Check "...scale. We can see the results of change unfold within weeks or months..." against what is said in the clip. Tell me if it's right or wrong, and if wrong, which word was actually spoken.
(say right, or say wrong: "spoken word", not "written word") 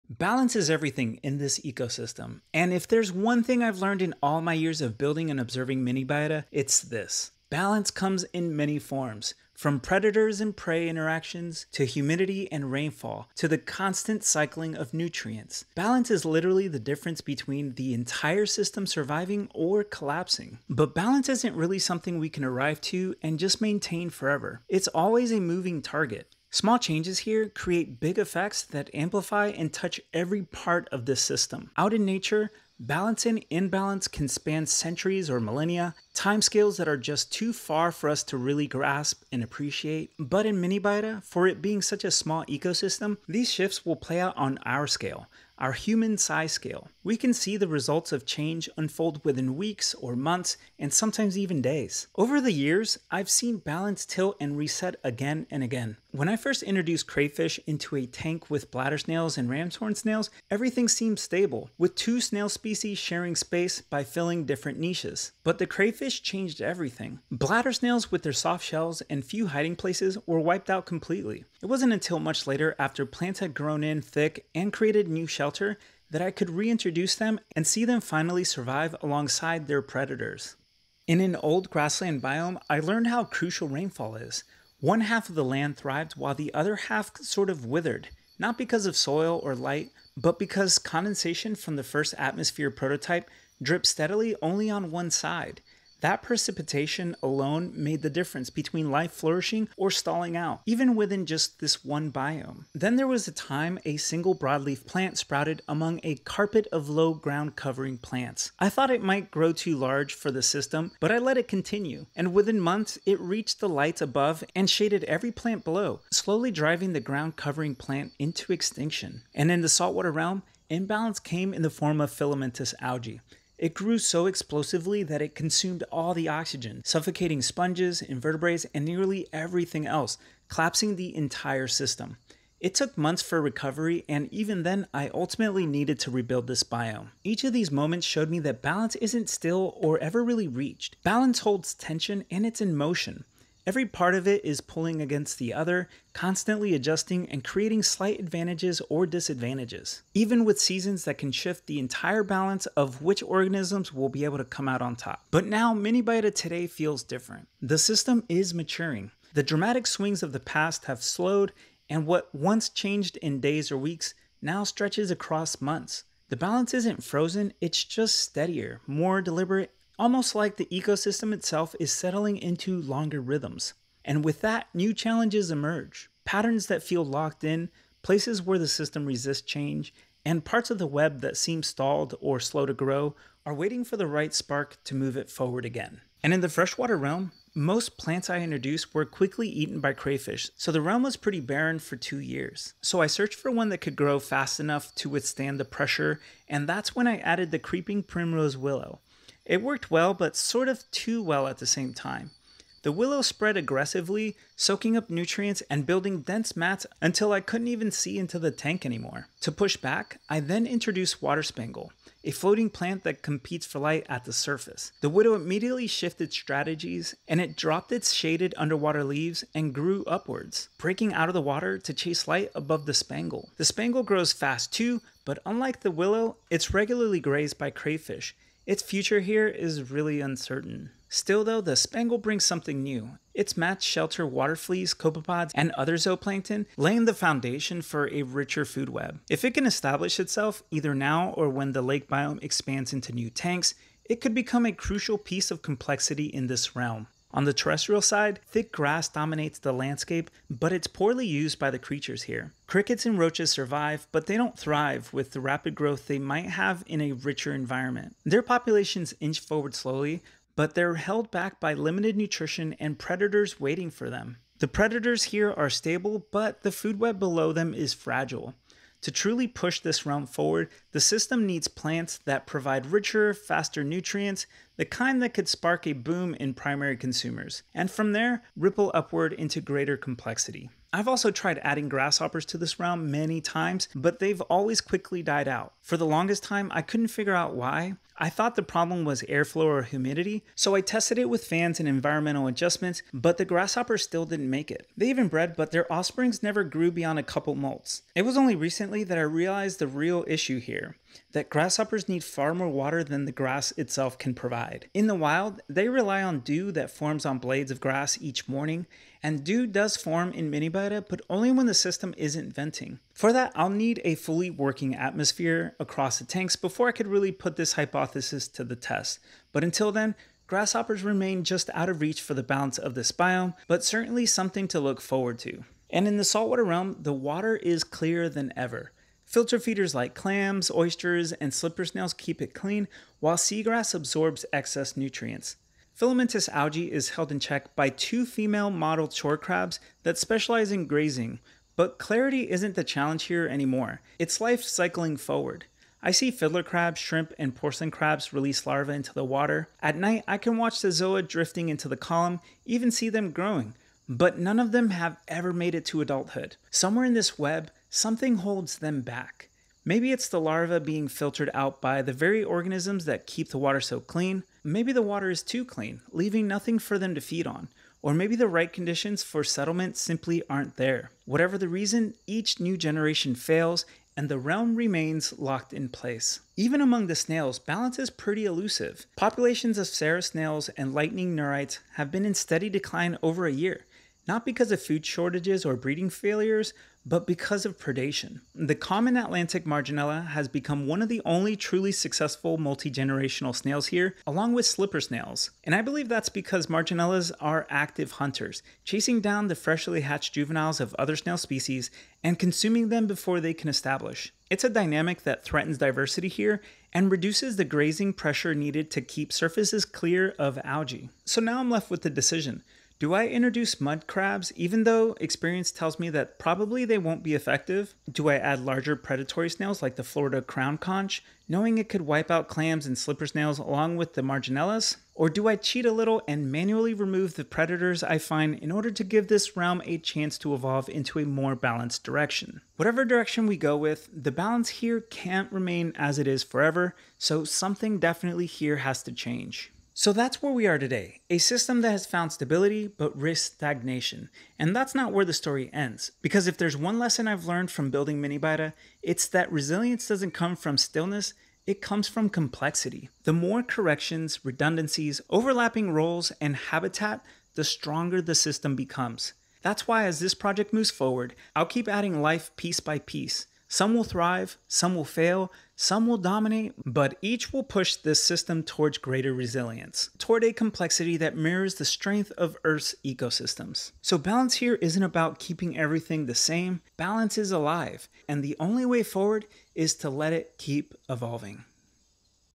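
right.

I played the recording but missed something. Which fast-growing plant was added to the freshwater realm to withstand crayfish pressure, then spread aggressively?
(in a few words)
Creeping primrose willow.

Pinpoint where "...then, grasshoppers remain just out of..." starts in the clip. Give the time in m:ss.
5:19.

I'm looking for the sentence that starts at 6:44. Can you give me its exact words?
It's a dynamic that threatens diversity here and reduces the grazing pressure needed to keep surfaces clear of algae.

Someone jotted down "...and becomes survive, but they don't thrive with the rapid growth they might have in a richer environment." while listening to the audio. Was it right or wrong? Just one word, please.
wrong.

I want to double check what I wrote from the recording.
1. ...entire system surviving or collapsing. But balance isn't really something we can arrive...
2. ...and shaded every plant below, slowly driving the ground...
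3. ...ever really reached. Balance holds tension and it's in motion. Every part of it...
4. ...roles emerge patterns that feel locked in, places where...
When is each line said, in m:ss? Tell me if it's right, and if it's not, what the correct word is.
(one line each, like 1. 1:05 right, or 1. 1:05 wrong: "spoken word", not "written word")
1. 0:17 right
2. 1:54 right
3. 2:19 right
4. 2:54 wrong: "challenges", not "roles".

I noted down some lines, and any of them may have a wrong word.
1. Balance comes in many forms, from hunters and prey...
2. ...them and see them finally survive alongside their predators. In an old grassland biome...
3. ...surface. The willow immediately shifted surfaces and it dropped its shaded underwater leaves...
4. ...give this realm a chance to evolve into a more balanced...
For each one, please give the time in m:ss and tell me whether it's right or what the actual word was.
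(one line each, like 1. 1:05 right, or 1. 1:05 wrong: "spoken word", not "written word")
1. 0:07 wrong: "predators", not "hunters"
2. 1:17 right
3. 3:34 wrong: "strategies", not "surfaces"
4. 7:09 right.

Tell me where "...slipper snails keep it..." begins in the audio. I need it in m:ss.
5:31.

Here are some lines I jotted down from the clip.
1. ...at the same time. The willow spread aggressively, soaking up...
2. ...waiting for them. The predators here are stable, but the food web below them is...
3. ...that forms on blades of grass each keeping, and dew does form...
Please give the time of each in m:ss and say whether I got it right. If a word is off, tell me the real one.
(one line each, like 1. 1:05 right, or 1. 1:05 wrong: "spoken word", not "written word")
1. 3:21 right
2. 4:23 right
3. 5:06 wrong: "morning", not "keeping".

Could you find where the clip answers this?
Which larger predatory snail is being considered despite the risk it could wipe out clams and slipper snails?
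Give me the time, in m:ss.
7:00.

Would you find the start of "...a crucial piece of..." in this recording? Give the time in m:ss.
4:04.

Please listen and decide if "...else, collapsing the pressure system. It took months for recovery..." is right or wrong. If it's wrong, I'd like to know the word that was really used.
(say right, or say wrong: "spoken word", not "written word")
wrong: "entire", not "pressure".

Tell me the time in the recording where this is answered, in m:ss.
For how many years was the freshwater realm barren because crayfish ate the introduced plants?
3:11.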